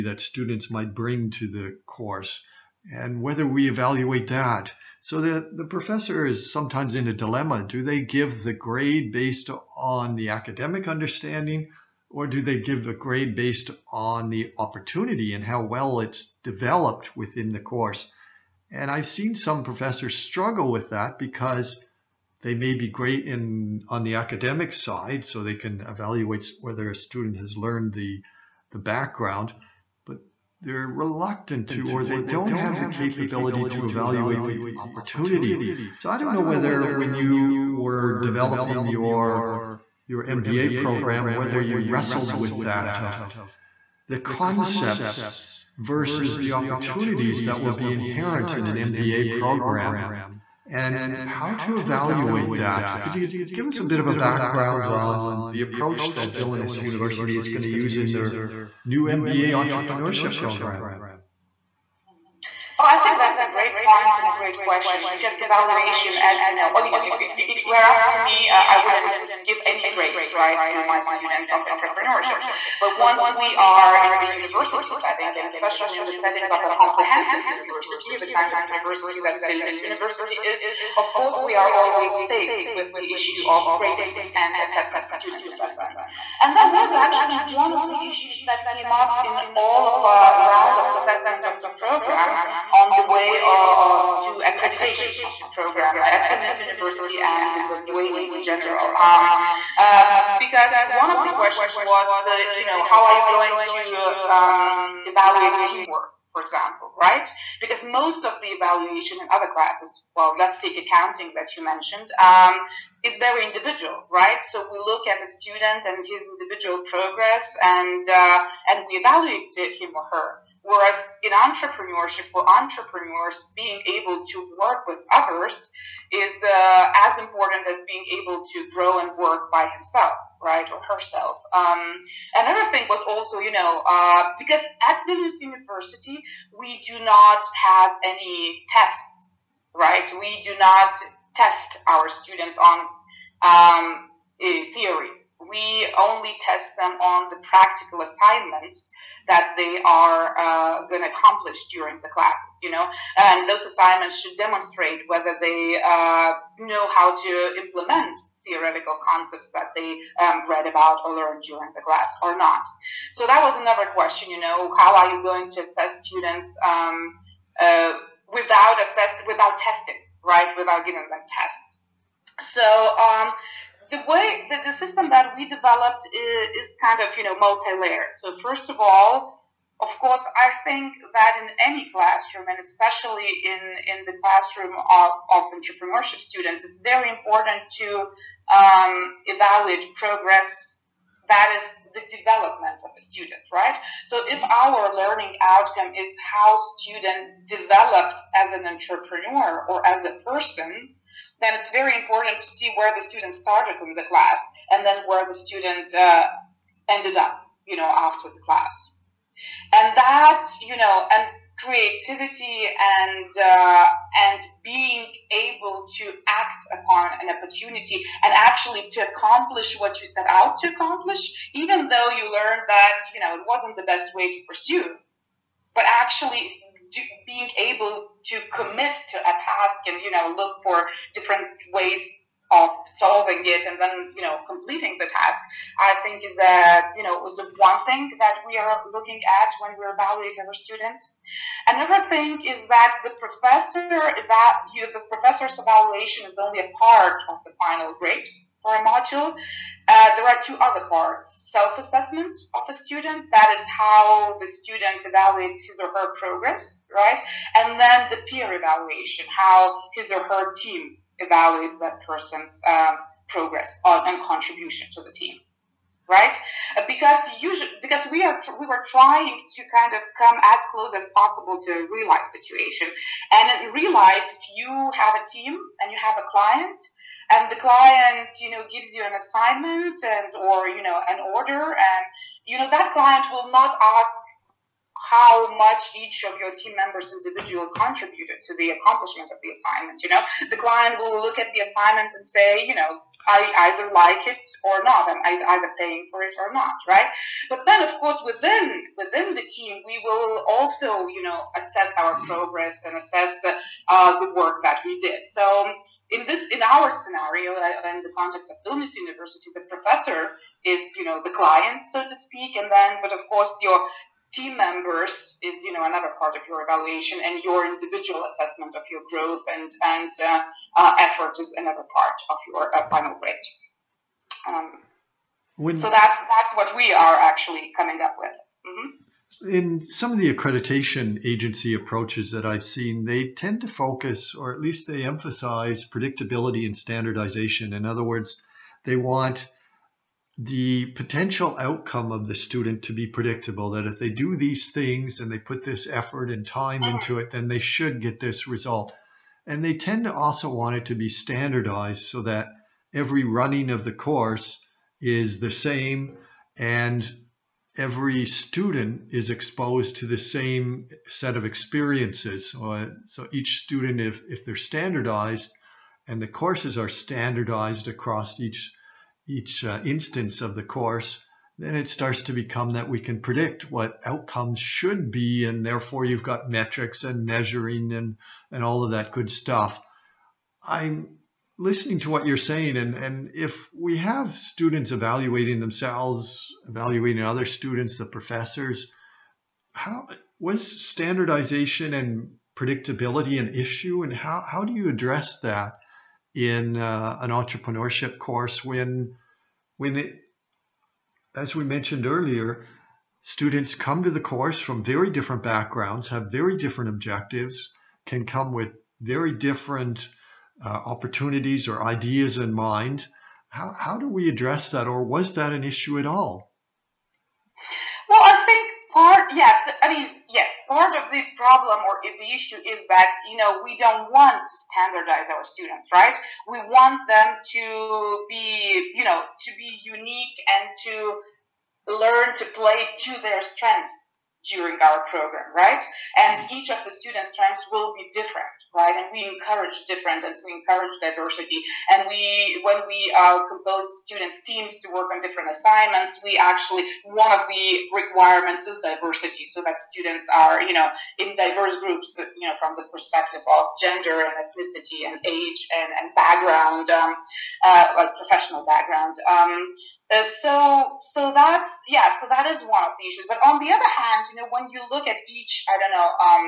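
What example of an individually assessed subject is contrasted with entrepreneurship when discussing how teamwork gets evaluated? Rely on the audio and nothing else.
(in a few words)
Accounting.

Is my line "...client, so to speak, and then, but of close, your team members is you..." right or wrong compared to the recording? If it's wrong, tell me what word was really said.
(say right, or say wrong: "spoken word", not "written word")
wrong: "course", not "close".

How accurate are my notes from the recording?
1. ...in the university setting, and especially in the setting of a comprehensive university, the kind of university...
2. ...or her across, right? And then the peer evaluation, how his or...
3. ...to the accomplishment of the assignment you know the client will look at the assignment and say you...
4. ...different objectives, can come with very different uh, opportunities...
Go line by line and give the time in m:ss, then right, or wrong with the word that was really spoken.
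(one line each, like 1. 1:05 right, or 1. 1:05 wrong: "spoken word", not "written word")
1. 1:14 right
2. 4:15 wrong: "progress", not "across"
3. 4:48 right
4. 6:46 right.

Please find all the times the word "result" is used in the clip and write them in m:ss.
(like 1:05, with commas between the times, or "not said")
5:48.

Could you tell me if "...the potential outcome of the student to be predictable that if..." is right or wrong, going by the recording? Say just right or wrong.
right.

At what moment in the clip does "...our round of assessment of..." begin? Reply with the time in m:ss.
1:30.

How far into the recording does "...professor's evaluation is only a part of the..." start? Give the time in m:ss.
4:05.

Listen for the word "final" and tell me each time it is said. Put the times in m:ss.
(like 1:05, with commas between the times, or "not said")
4:07, 5:22.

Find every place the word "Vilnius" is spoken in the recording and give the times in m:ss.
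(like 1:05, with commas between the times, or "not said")
0:56, 1:19, 1:36, 2:15, 5:08.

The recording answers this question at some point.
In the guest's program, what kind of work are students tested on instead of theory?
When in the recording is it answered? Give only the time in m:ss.
2:27.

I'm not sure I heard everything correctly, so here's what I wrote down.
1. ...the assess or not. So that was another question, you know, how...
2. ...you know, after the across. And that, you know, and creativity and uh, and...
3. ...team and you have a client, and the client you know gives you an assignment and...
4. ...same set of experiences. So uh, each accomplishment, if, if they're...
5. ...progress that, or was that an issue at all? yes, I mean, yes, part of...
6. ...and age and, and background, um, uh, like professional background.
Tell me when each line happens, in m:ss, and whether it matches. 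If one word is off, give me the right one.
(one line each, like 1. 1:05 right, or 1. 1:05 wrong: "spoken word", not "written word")
1. 2:41 wrong: "class", not "assess"
2. 3:27 wrong: "class", not "across"
3. 4:35 right
4. 6:00 wrong: "student", not "accomplishment"
5. 6:54 wrong: "address", not "progress"
6. 7:35 right.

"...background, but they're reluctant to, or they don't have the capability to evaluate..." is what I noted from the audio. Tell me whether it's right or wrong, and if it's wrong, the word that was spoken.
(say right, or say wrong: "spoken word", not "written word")
right.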